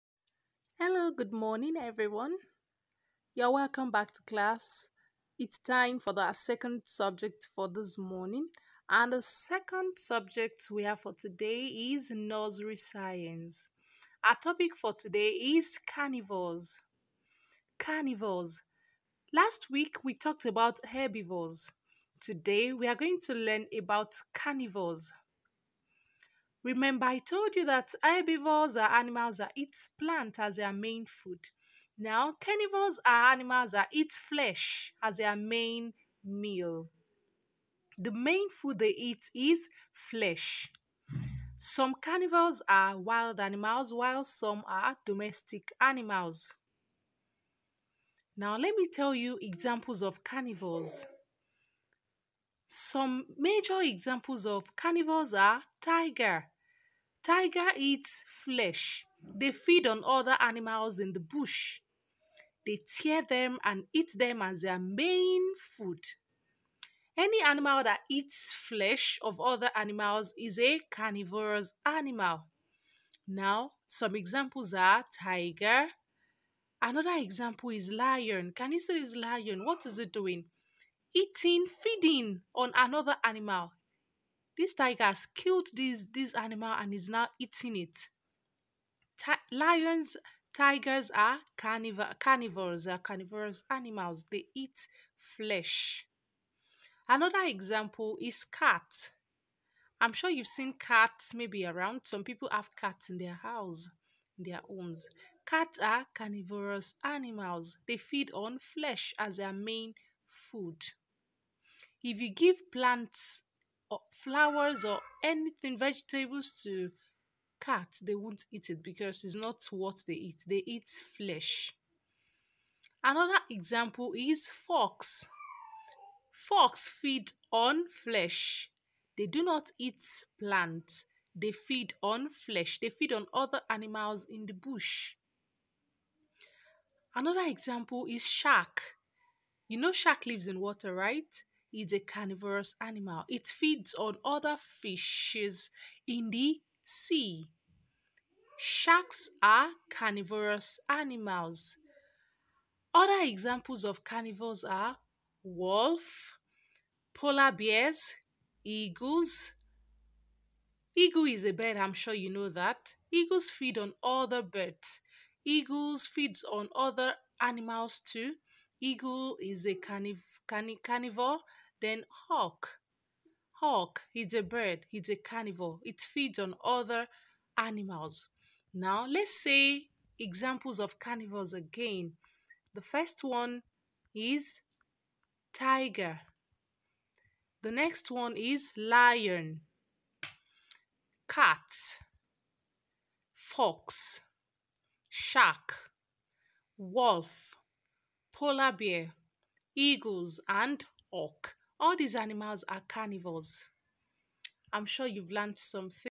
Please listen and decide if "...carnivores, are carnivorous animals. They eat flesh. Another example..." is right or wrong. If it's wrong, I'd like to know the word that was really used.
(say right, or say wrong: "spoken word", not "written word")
right.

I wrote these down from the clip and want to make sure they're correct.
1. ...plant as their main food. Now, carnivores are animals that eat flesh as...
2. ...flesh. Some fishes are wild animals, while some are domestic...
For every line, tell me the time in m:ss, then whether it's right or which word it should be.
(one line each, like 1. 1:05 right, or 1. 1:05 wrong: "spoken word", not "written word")
1. 0:29 right
2. 0:39 wrong: "carnivores", not "fishes".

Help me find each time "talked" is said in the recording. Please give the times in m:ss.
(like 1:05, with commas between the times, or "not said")
0:20.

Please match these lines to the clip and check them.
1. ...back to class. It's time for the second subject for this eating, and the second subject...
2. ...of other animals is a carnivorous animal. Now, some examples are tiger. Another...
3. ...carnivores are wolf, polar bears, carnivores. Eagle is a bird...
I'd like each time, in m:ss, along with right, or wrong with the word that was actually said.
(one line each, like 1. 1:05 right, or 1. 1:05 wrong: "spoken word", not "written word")
1. 0:03 wrong: "morning", not "eating"
2. 1:09 right
3. 2:34 wrong: "eagles", not "carnivores".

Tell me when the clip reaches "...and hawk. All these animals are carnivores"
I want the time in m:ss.
3:20.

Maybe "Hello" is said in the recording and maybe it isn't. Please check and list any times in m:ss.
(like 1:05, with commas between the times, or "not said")
0:00.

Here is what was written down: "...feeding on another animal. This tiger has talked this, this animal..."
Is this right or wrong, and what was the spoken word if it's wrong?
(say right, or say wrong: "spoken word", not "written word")
wrong: "killed", not "talked".